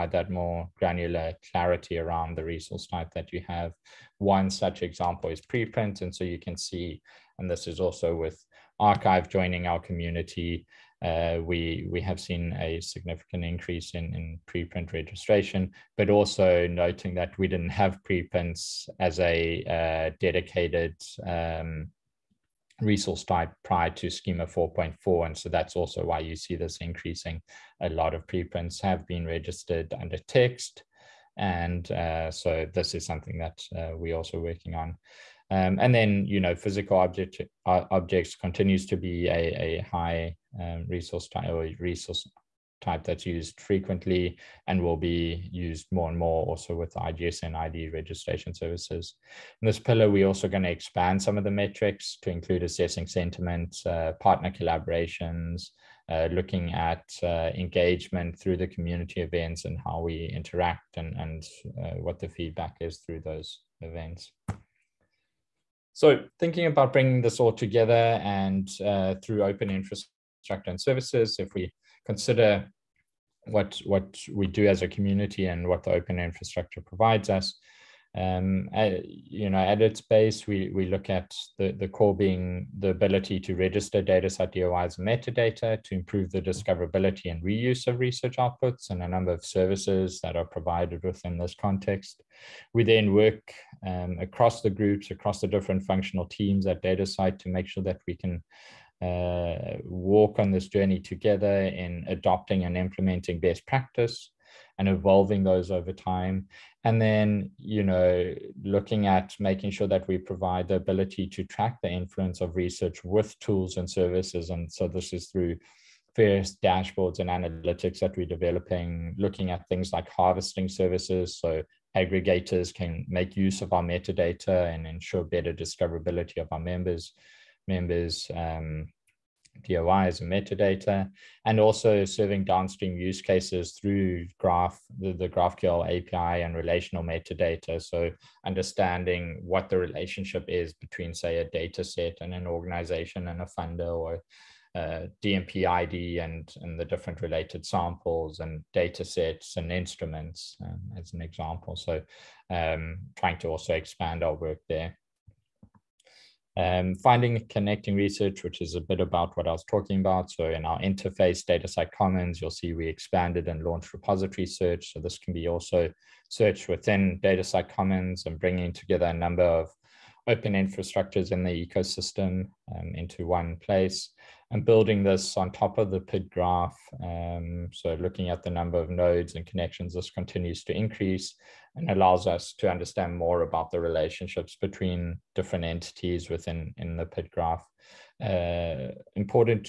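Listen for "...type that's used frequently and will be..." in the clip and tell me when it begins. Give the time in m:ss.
0:42.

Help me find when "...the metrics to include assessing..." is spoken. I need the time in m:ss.
0:51.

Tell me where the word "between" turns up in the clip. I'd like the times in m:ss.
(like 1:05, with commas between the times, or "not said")
2:20, 3:04.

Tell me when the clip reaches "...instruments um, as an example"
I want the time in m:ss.
2:29.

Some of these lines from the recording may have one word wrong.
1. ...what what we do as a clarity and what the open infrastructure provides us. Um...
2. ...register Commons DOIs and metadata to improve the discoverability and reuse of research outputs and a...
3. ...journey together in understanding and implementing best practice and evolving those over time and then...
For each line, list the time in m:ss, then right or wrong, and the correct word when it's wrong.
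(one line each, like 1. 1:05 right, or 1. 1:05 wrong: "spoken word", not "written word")
1. 1:13 wrong: "community", not "clarity"
2. 1:23 wrong: "DataCite", not "Commons"
3. 1:40 wrong: "adopting", not "understanding".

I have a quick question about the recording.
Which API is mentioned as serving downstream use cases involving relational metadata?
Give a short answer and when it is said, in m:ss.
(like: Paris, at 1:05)
GraphQL API, at 2:15.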